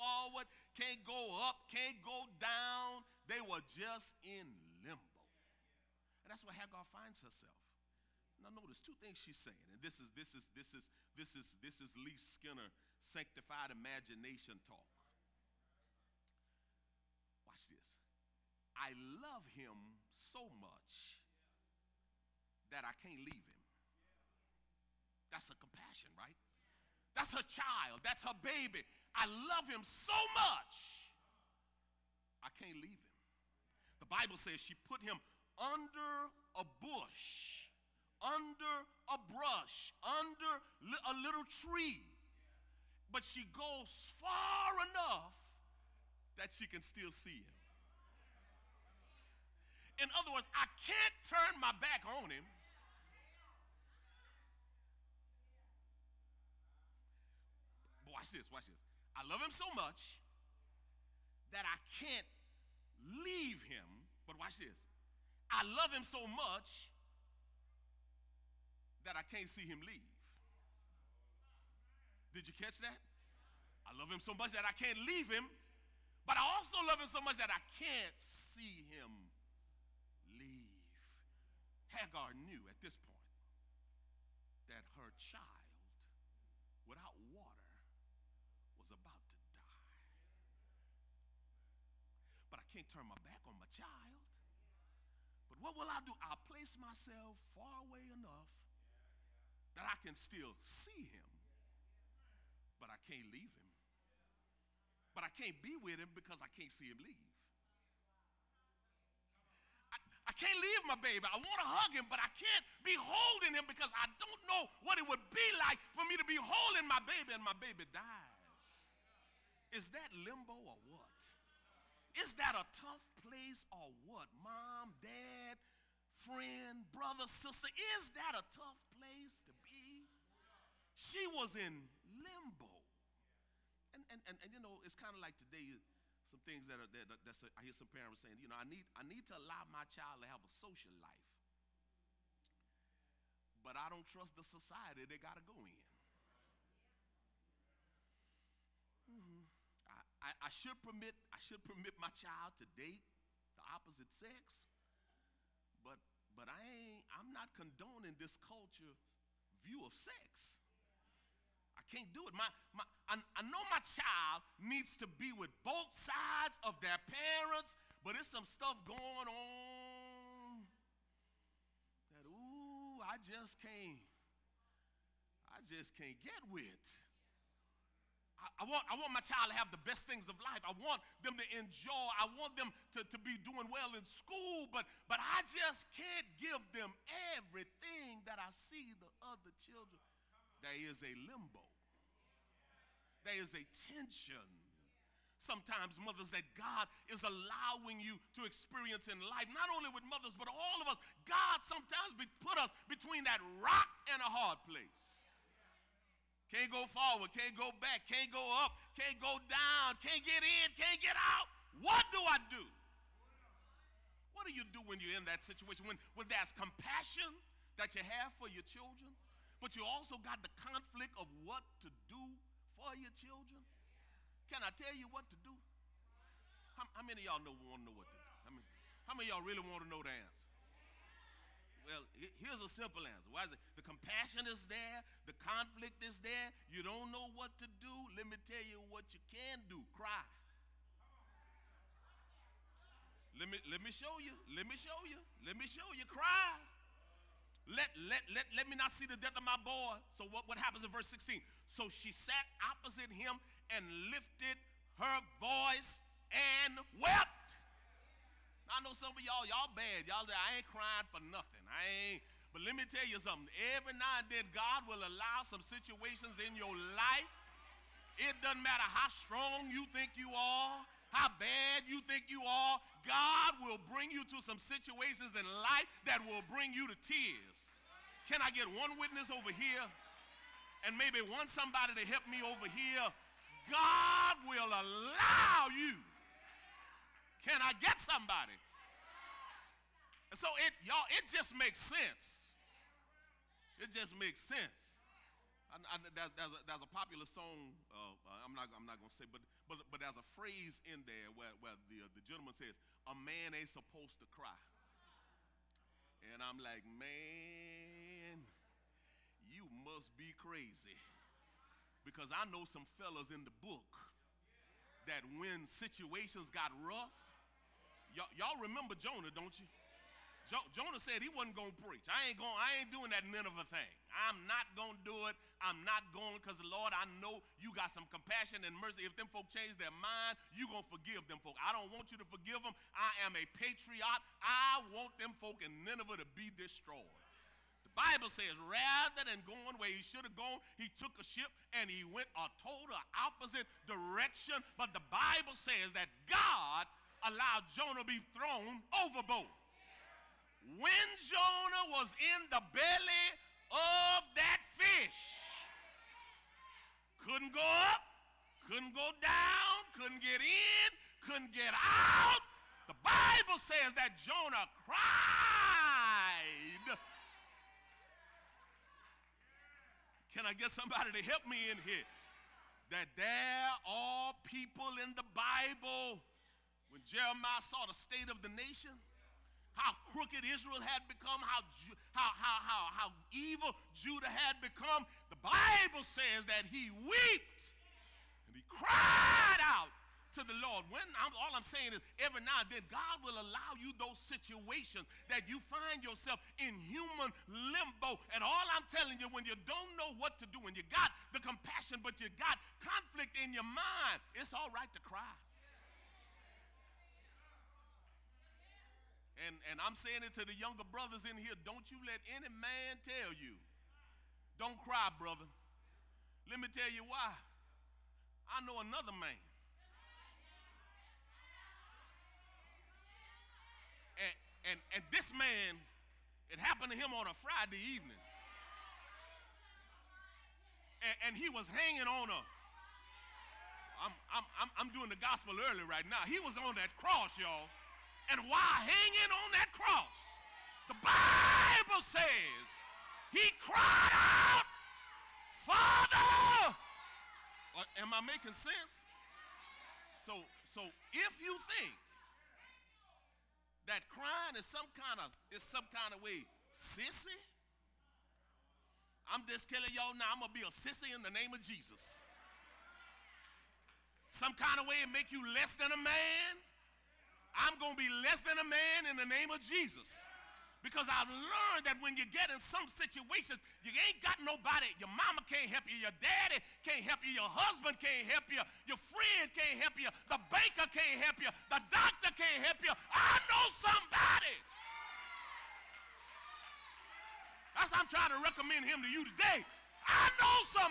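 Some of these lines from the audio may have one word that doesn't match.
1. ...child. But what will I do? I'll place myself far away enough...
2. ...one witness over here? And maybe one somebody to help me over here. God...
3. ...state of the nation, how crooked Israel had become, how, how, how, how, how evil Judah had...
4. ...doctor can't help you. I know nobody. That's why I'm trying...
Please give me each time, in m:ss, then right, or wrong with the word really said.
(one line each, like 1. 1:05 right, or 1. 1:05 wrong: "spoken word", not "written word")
1. 1:33 right
2. 4:38 right
3. 6:17 right
4. 8:01 wrong: "somebody", not "nobody".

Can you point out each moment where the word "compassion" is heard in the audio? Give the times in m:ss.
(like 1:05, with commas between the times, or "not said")
0:25, 3:36, 3:53, 5:28, 6:41.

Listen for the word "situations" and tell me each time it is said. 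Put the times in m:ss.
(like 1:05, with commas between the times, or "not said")
3:35, 4:25, 4:34, 5:15, 6:34, 7:52.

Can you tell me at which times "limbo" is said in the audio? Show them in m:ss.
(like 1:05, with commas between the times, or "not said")
0:04, 2:00, 2:12, 3:11, 6:37.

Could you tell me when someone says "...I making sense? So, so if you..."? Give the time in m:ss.
7:28.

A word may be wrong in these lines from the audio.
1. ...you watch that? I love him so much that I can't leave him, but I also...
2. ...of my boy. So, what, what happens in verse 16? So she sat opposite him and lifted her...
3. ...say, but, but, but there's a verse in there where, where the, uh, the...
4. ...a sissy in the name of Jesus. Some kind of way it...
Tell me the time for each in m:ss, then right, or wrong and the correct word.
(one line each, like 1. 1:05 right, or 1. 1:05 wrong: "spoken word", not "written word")
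1. 1:12 wrong: "catch", not "watch"
2. 4:09 right
3. 4:59 wrong: "phrase", not "verse"
4. 7:40 right.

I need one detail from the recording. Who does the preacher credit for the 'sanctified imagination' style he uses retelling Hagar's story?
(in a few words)
Lee Skinner.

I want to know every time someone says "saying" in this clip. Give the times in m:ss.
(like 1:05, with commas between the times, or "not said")
0:09, 2:18, 6:31, 6:49.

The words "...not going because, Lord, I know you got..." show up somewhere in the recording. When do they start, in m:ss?
5:25.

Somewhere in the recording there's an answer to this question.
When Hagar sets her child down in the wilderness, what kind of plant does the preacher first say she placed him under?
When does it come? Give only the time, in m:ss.
0:36.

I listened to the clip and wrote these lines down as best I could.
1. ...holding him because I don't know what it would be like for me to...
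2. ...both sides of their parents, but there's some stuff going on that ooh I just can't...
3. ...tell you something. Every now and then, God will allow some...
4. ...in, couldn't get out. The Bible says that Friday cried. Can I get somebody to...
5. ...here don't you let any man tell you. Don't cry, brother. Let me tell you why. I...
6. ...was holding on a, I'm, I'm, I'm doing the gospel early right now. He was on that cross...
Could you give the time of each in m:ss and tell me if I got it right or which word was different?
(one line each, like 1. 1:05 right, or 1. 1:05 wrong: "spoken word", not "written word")
1. 1:52 right
2. 2:45 right
3. 4:22 right
4. 6:00 wrong: "Jonah", not "Friday"
5. 6:51 right
6. 7:11 wrong: "hanging", not "holding".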